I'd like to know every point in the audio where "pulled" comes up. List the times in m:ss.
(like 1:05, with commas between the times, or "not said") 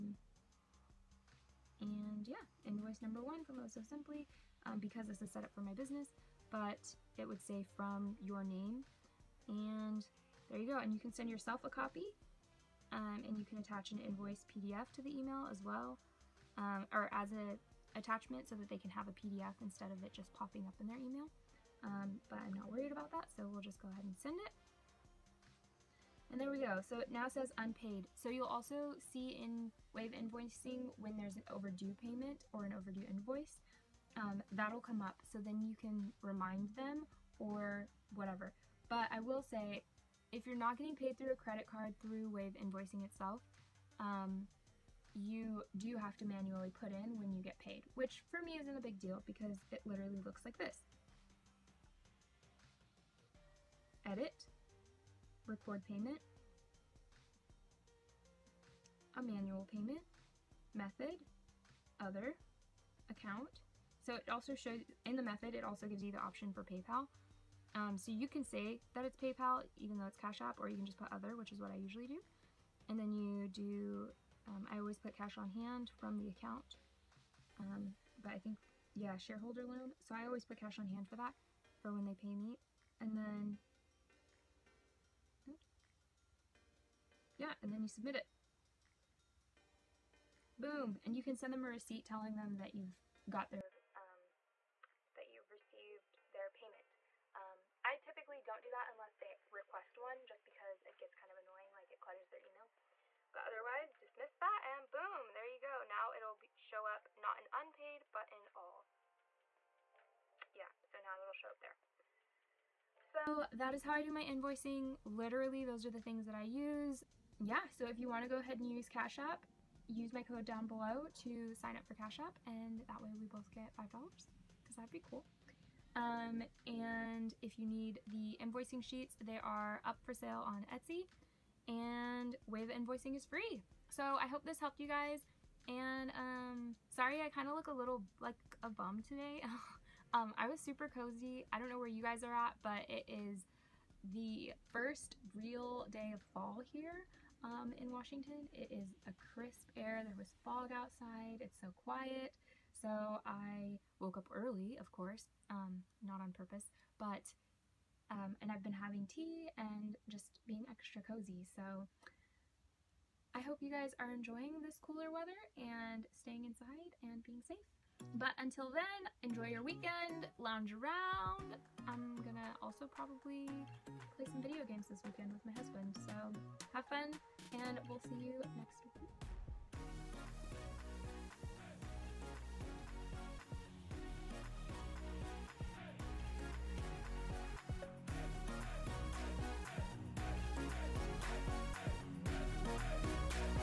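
not said.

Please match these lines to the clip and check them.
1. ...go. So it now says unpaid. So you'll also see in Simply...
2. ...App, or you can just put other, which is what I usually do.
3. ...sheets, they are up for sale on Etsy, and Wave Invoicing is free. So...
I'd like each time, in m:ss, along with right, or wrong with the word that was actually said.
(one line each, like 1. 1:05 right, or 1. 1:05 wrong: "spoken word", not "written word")
1. 0:26 wrong: "Wave", not "Simply"
2. 1:10 right
3. 2:08 right.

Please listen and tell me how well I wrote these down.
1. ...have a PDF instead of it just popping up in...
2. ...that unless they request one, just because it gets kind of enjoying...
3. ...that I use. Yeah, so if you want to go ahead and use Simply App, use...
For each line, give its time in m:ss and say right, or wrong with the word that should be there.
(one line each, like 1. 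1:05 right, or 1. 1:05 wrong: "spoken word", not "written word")
1. 0:18 right
2. 1:38 wrong: "annoying", not "enjoying"
3. 1:56 wrong: "Cash", not "Simply".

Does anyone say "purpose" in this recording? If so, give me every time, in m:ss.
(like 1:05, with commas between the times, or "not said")
2:36.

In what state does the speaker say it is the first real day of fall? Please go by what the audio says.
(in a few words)
Washington.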